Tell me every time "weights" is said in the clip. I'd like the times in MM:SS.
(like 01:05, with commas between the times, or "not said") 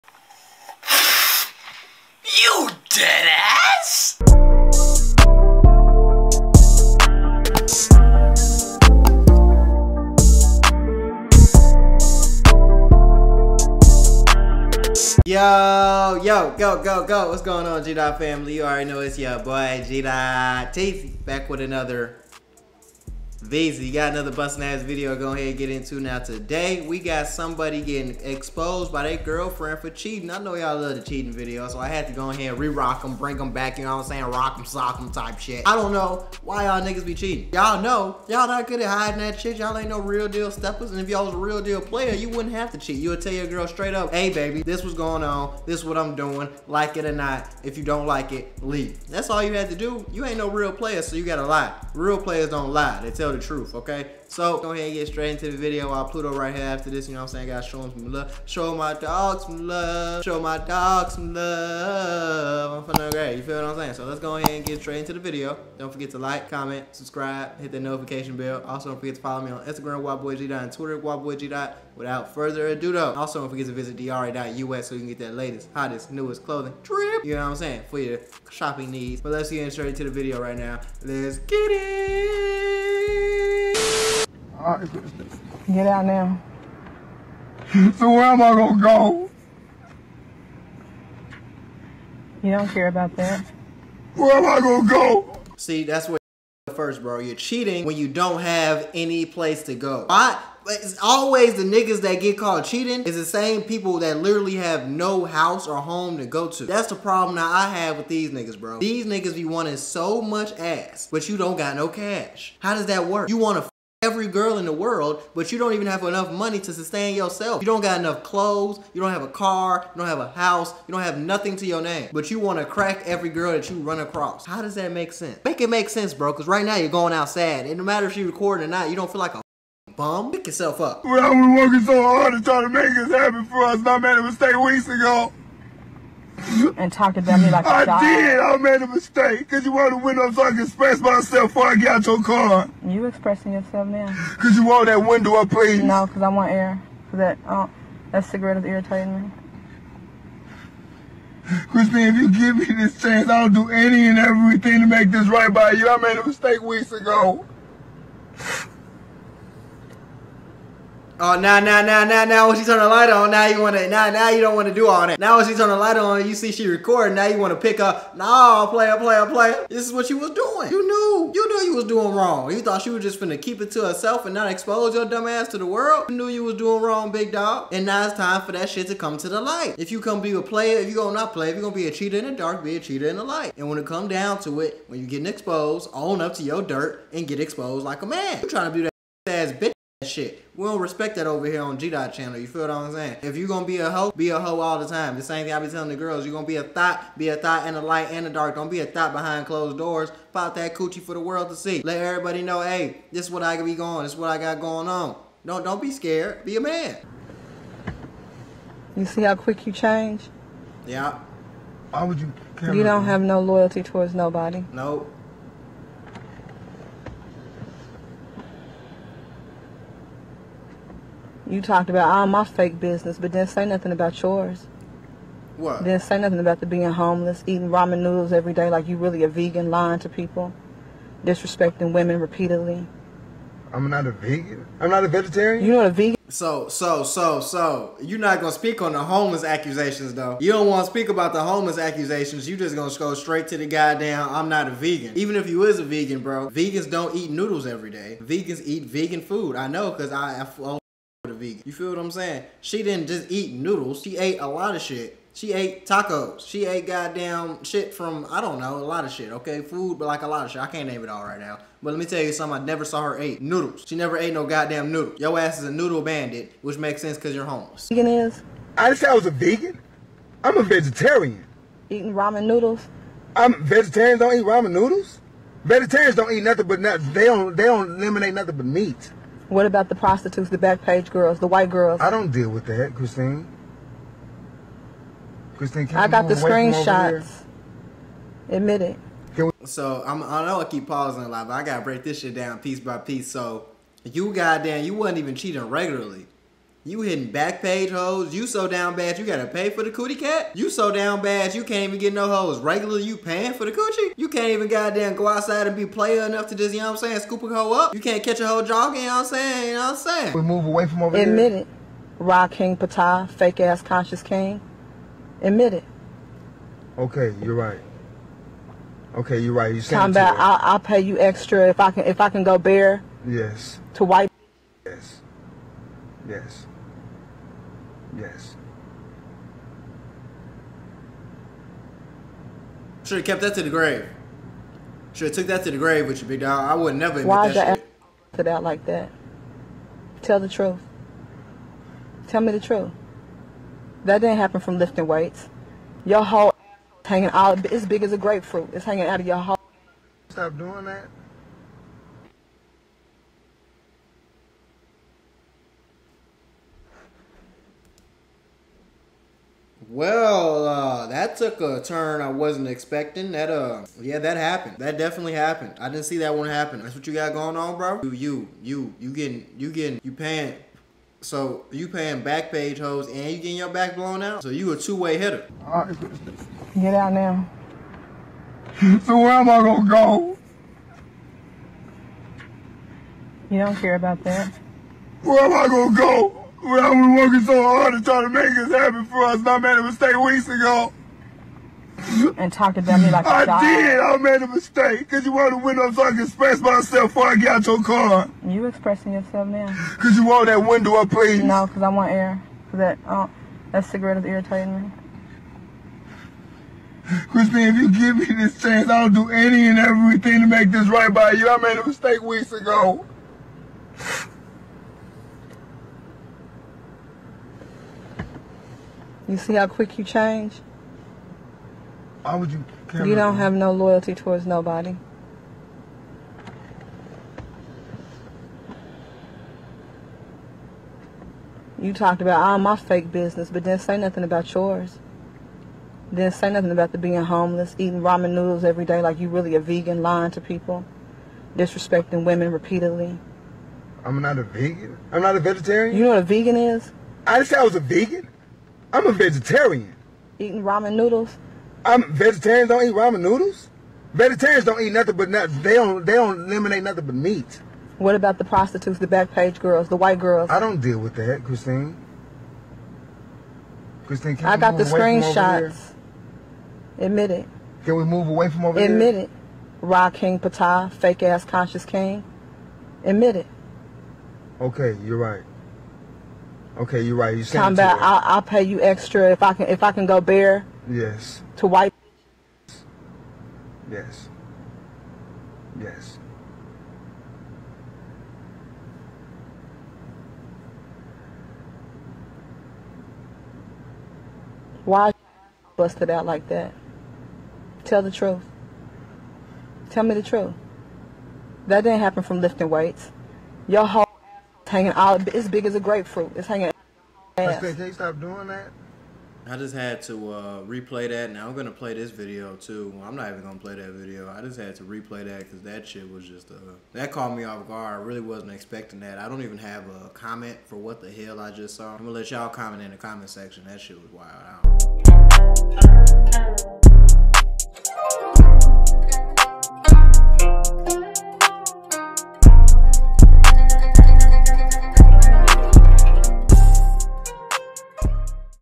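05:45, 08:22.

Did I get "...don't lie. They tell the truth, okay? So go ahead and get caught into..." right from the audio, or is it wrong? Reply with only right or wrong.
wrong.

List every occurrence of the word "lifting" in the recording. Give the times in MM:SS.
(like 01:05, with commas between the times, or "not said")
05:44, 08:22.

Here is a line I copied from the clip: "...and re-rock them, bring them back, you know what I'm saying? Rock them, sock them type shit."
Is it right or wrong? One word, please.
right.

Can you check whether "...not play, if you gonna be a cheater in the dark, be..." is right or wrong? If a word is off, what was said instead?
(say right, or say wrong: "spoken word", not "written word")
right.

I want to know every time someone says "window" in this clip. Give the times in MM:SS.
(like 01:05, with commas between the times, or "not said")
02:19, 02:25, 06:35, 06:40.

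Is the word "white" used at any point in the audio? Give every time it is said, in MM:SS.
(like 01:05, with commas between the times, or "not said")
04:41, 05:24, 07:39, 08:01.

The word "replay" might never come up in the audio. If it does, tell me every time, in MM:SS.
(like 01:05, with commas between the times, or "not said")
08:30, 08:34.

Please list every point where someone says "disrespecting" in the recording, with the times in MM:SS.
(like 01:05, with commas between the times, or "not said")
03:51, 07:21.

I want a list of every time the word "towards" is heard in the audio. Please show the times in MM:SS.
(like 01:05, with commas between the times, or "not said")
03:33, 07:04.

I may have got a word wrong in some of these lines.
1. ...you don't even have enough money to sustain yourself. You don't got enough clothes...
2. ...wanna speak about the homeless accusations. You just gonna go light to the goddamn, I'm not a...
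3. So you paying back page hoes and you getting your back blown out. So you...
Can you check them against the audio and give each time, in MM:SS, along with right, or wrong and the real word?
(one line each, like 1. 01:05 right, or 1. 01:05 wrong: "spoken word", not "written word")
1. 01:55 right
2. 04:00 wrong: "straight", not "light"
3. 06:11 right.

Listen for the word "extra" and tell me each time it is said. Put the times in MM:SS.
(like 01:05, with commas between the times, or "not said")
05:21, 07:58.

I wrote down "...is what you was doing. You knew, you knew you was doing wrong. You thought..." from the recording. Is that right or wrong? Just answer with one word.
right.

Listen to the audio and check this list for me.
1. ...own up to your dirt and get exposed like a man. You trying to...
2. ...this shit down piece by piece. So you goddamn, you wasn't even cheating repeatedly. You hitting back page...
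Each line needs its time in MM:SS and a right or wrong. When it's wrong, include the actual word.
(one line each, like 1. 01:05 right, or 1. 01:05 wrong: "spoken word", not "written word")
1. 03:05 right
2. 04:52 wrong: "regularly", not "repeatedly".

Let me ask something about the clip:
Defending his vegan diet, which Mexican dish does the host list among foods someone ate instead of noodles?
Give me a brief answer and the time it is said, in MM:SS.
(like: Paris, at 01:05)
Tacos, at 04:15.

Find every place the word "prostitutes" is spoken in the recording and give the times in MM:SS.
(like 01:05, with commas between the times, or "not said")
04:39, 07:38.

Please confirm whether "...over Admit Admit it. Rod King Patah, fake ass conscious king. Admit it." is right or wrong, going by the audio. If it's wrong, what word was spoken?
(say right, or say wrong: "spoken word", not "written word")
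right.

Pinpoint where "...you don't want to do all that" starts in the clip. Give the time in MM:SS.
02:44.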